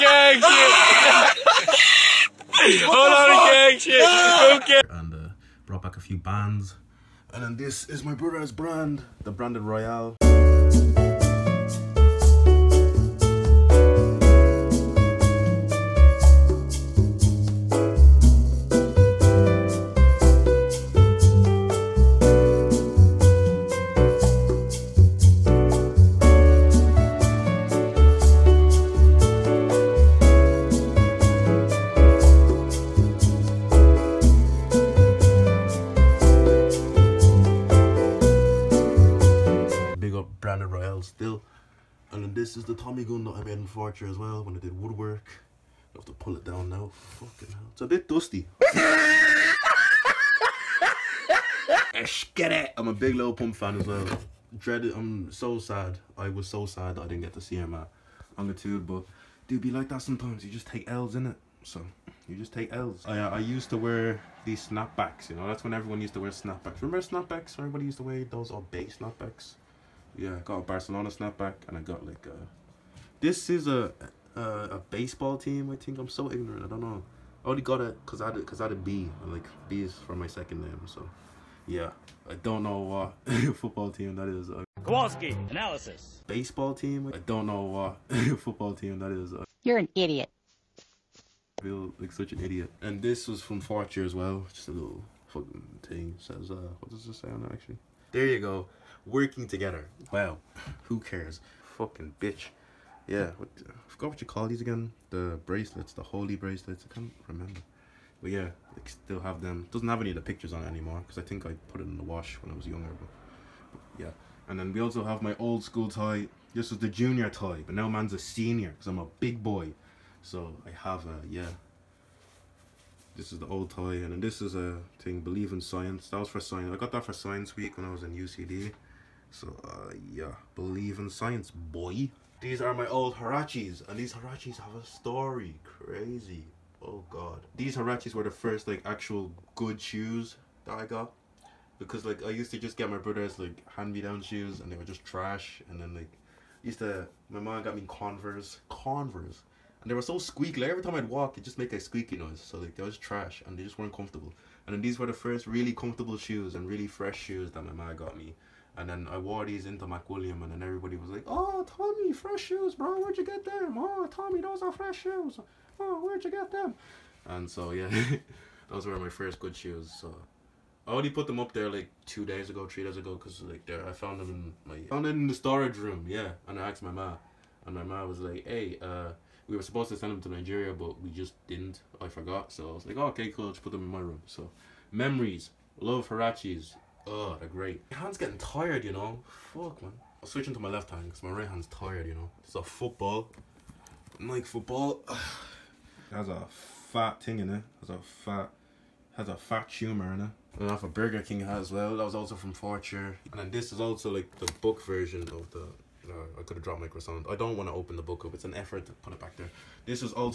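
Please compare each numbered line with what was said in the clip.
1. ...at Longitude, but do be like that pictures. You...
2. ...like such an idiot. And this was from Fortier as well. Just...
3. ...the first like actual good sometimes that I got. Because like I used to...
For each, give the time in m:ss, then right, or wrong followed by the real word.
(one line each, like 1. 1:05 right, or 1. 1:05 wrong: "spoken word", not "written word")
1. 0:57 wrong: "sometimes", not "pictures"
2. 1:31 right
3. 2:18 wrong: "shoes", not "sometimes".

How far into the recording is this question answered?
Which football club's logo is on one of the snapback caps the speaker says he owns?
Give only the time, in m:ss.
1:10.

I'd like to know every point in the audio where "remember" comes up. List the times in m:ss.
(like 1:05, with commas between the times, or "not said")
1:06, 1:47.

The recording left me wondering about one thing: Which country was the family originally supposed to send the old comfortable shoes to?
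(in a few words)
Nigeria.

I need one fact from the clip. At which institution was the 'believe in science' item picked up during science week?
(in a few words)
UCD.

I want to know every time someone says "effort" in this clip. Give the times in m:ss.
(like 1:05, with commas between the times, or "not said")
3:28.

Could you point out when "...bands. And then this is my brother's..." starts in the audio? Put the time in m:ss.
0:06.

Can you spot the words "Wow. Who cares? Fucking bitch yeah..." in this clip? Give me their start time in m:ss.
1:40.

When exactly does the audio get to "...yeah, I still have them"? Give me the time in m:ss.
1:48.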